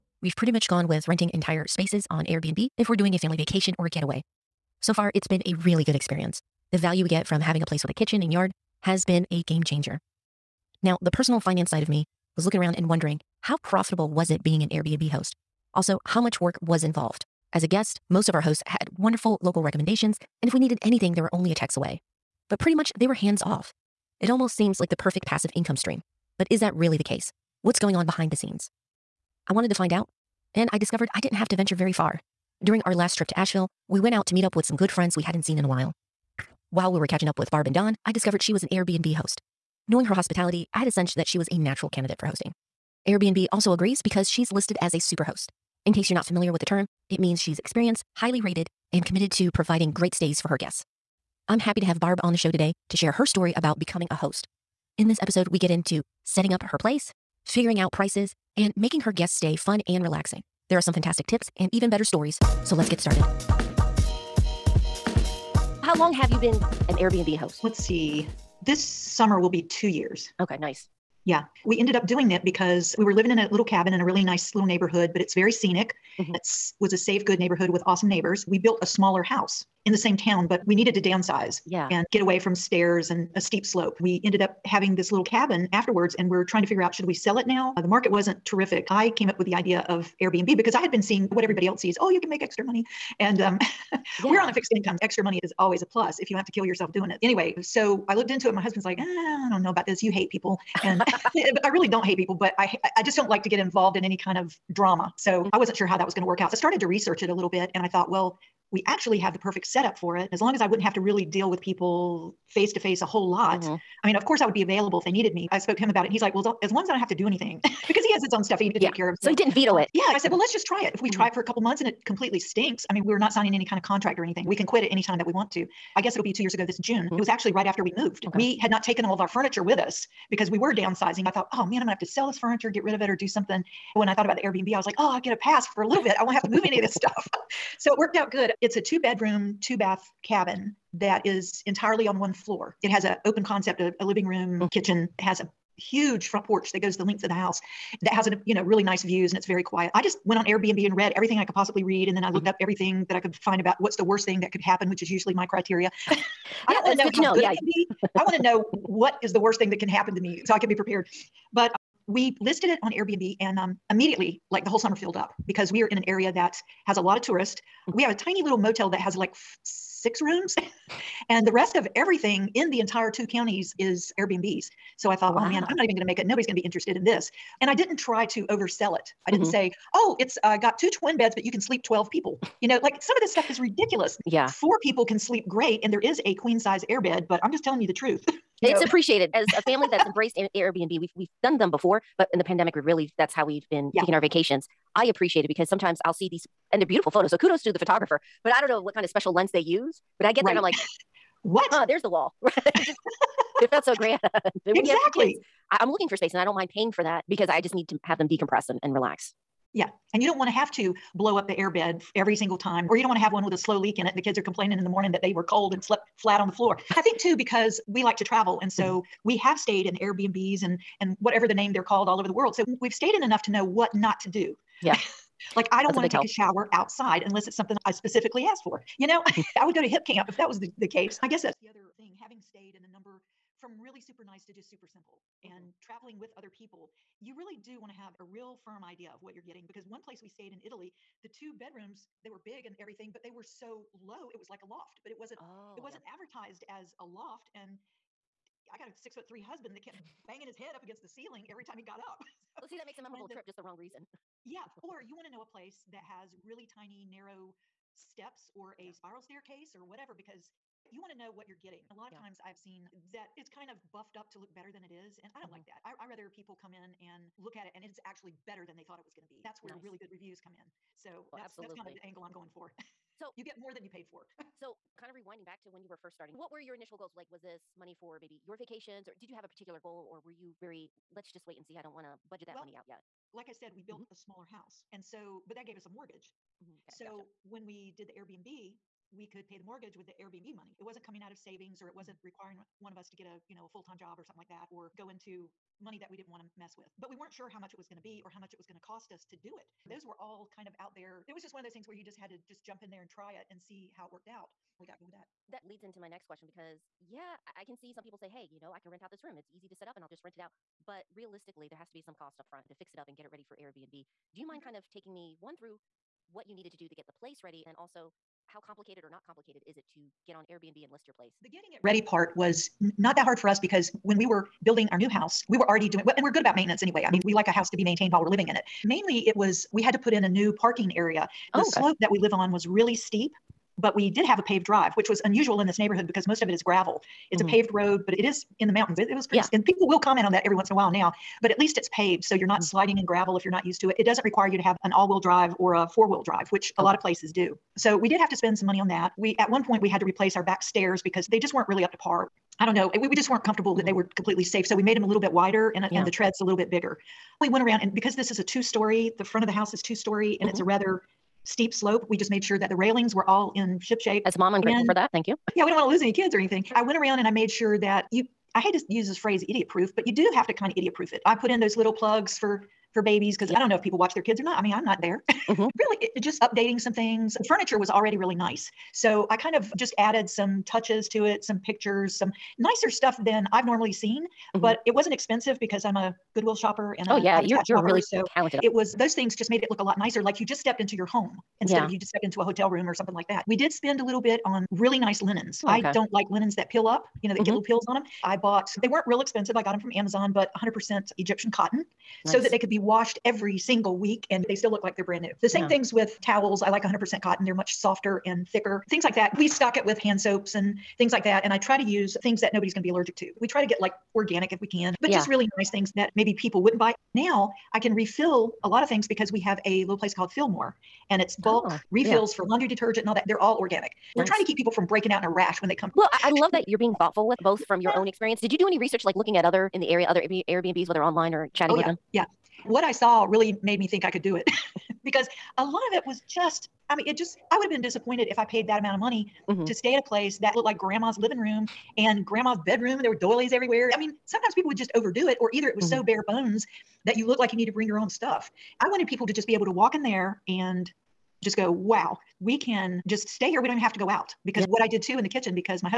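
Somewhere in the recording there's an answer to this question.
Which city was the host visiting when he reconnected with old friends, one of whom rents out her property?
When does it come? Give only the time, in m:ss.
0:33.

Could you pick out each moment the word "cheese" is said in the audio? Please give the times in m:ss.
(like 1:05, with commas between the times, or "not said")
not said.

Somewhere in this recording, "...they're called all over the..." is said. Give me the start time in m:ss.
3:41.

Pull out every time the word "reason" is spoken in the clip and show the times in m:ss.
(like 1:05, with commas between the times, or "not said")
4:13.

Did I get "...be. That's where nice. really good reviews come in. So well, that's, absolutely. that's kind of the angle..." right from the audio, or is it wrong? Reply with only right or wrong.
right.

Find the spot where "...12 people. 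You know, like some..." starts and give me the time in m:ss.
3:01.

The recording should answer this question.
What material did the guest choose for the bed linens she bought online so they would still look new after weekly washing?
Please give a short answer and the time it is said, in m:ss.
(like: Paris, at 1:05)
Egyptian cotton, at 6:41.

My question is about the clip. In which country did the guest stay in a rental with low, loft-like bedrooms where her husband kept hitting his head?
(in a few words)
Italy.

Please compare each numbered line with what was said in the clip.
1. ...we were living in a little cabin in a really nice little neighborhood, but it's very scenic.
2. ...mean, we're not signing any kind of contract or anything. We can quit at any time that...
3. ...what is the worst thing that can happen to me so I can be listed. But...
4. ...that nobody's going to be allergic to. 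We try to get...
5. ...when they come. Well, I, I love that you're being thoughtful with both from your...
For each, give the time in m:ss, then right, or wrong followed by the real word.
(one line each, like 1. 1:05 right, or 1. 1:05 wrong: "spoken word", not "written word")
1. 1:12 right
2. 2:02 right
3. 2:38 wrong: "prepared", not "listed"
4. 6:52 right
5. 7:05 right.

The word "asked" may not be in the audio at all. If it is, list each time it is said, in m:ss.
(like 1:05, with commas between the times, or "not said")
3:48.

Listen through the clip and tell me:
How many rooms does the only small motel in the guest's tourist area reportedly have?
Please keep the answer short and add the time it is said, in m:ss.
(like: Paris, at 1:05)
6, at 2:49.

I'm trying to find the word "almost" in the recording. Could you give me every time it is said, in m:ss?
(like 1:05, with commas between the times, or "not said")
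0:24.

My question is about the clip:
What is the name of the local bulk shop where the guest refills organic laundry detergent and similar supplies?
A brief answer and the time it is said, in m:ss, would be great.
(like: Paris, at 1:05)
Fillmore, at 7:00.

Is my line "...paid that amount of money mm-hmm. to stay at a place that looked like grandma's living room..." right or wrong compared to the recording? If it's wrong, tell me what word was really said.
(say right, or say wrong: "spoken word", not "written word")
right.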